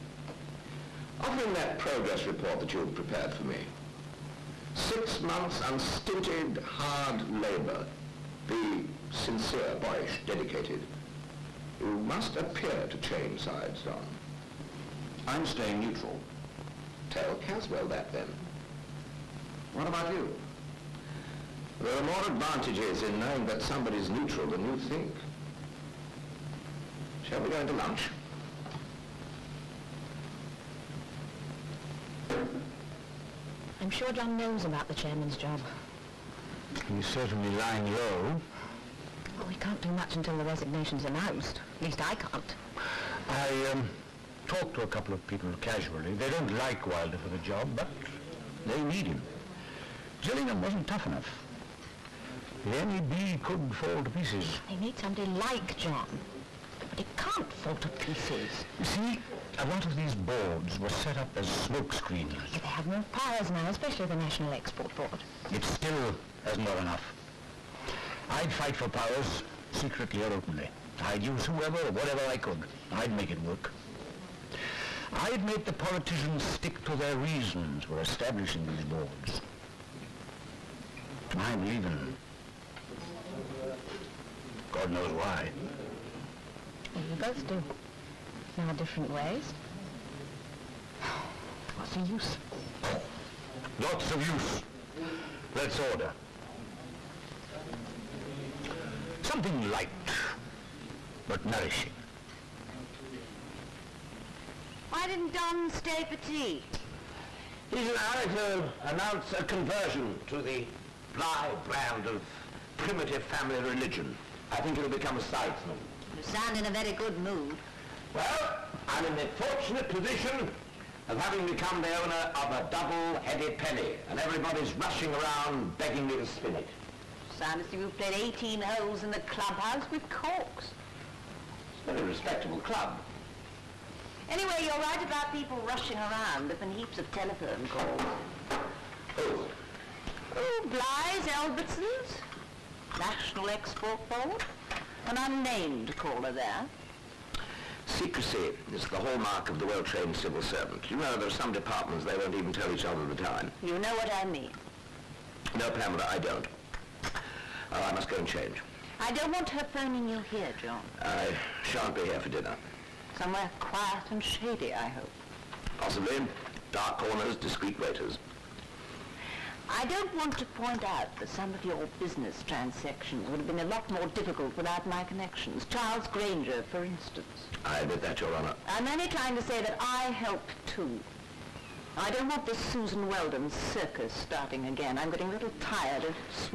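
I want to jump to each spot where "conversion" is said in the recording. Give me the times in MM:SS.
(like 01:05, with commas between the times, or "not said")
01:49.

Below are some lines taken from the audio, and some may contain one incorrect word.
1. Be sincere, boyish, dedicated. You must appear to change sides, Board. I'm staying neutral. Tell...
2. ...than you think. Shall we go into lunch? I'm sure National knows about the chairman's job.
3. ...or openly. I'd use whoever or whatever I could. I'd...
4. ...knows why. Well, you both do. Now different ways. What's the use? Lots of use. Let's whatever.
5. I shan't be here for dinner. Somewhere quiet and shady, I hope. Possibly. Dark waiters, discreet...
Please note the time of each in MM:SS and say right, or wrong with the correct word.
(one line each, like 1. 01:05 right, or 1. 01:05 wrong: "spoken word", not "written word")
1. 00:08 wrong: "Don", not "Board"
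2. 00:24 wrong: "John", not "National"
3. 01:10 right
4. 01:24 wrong: "order", not "whatever"
5. 02:41 wrong: "corners", not "waiters".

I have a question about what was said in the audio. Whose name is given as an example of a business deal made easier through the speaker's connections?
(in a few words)
Charles Granger.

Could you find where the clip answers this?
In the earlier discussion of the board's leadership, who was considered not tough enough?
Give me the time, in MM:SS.
00:50.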